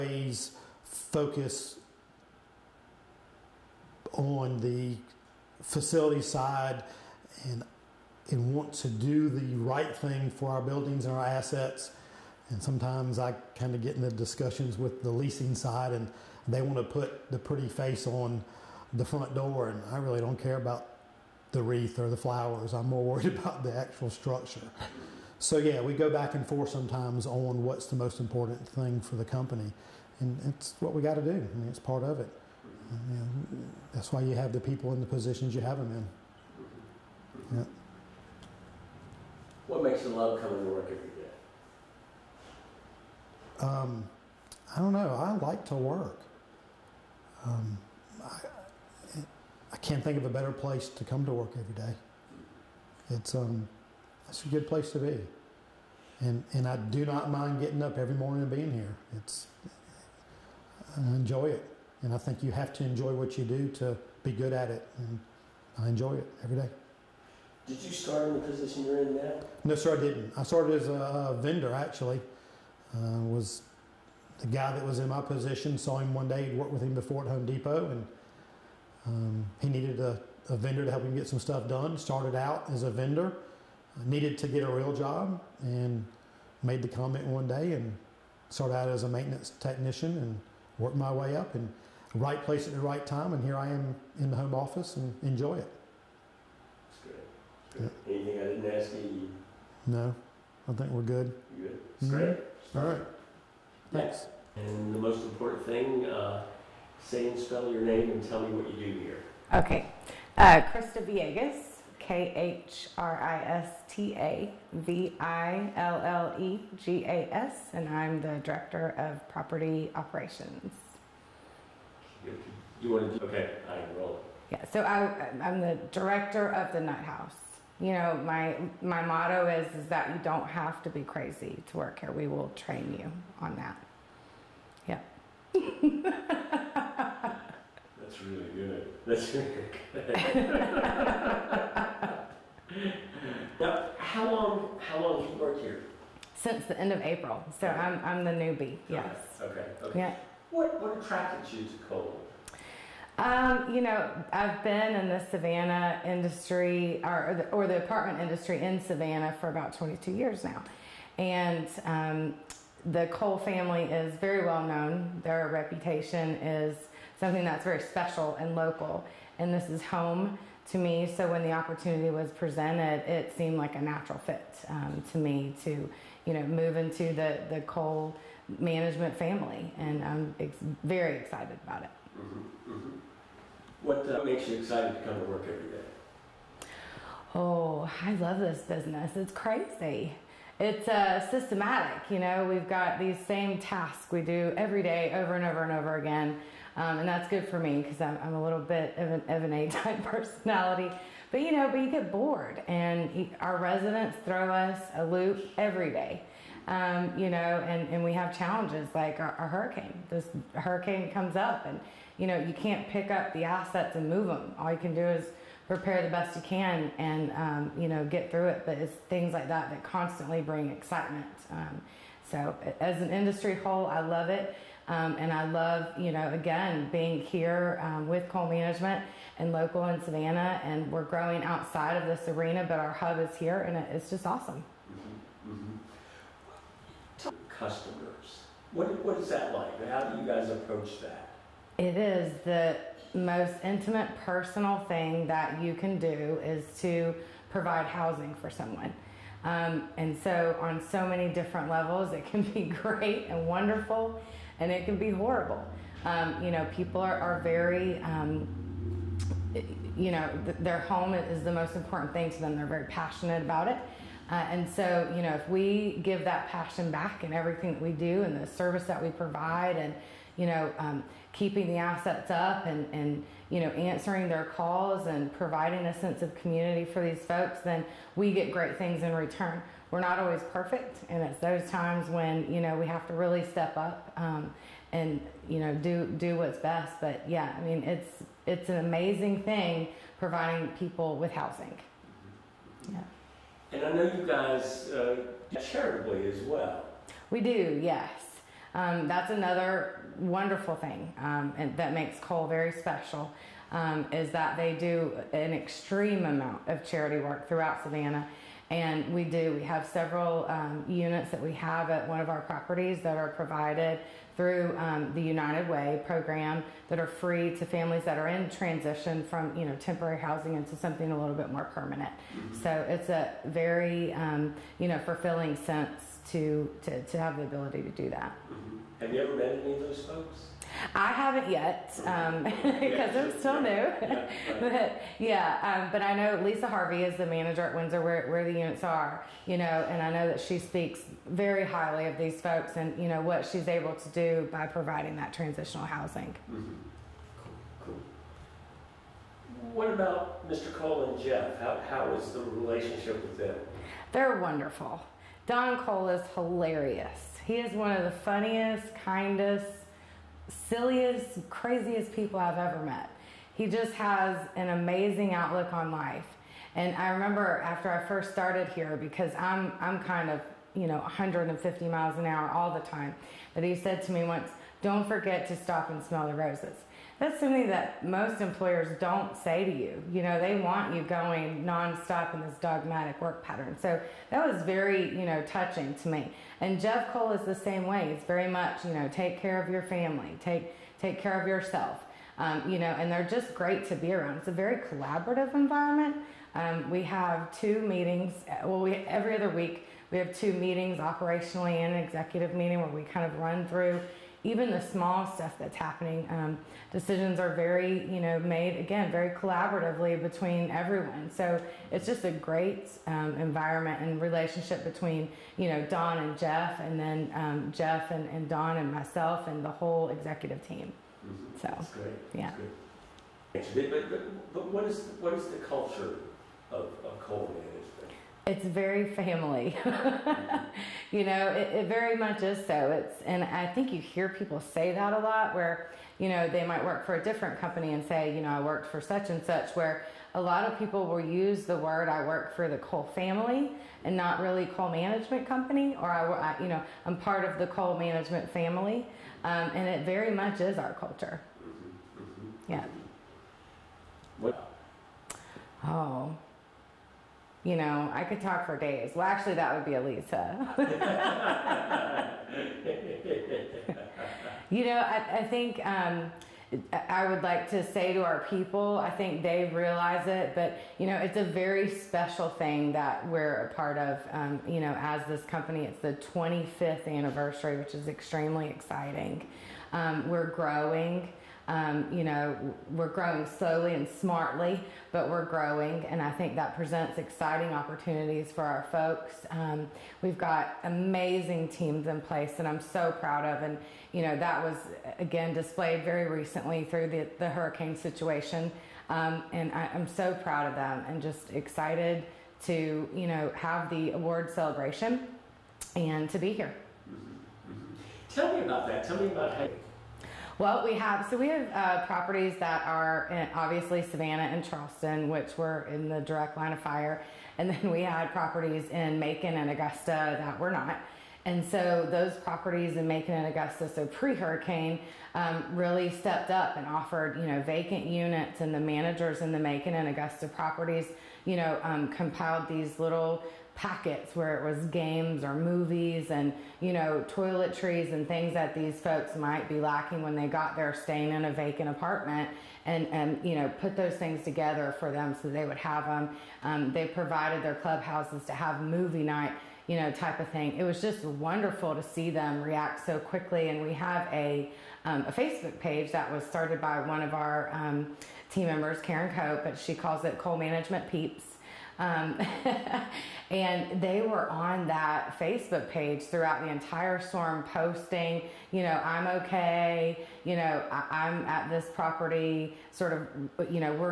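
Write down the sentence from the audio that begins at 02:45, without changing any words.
Their reputation is something that's very special and local.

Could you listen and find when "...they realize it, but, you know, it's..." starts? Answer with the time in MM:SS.
07:49.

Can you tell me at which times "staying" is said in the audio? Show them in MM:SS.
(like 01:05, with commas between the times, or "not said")
09:00.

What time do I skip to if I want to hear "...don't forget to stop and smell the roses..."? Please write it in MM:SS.
06:14.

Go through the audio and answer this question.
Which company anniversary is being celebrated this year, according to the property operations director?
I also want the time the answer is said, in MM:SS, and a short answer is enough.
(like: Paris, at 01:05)
25th, at 07:56.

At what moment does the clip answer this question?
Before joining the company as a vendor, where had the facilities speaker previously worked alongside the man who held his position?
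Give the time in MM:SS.
01:17.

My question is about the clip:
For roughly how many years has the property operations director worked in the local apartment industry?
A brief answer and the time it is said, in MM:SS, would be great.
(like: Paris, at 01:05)
22, at 02:39.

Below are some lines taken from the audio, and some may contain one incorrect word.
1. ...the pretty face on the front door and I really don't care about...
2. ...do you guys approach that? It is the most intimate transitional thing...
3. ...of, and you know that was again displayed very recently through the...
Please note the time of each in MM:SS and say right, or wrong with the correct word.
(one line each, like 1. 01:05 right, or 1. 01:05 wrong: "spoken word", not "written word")
1. 00:17 right
2. 04:00 wrong: "personal", not "transitional"
3. 08:13 right.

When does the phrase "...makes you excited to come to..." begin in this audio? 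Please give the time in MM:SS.
03:04.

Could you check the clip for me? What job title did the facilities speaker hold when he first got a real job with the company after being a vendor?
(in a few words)
maintenance technician.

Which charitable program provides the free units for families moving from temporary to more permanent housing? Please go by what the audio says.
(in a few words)
United Way.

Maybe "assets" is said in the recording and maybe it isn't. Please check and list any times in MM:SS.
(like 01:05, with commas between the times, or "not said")
00:11, 03:33, 04:31.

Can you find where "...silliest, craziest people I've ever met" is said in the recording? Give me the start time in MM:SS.
06:00.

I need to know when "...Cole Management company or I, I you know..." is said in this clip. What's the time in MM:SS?
07:24.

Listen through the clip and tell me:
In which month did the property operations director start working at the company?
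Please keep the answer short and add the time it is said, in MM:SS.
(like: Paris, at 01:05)
April, at 02:27.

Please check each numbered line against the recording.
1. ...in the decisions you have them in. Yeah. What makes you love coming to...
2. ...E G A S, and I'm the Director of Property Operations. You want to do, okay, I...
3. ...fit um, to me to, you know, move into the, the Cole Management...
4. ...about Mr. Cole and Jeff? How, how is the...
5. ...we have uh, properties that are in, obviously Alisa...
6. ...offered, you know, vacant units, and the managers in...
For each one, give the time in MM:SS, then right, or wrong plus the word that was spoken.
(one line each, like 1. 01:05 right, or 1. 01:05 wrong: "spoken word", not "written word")
1. 00:34 wrong: "positions", not "decisions"
2. 01:56 right
3. 02:54 right
4. 05:49 right
5. 08:31 wrong: "Savannah", not "Alisa"
6. 08:46 right.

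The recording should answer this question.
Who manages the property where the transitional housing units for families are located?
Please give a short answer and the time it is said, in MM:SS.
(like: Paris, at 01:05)
Lisa Harvey, at 05:36.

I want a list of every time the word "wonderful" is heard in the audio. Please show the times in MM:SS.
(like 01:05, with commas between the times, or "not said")
04:13, 05:00, 05:54, 09:11.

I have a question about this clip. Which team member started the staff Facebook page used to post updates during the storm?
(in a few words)
Karen Cope.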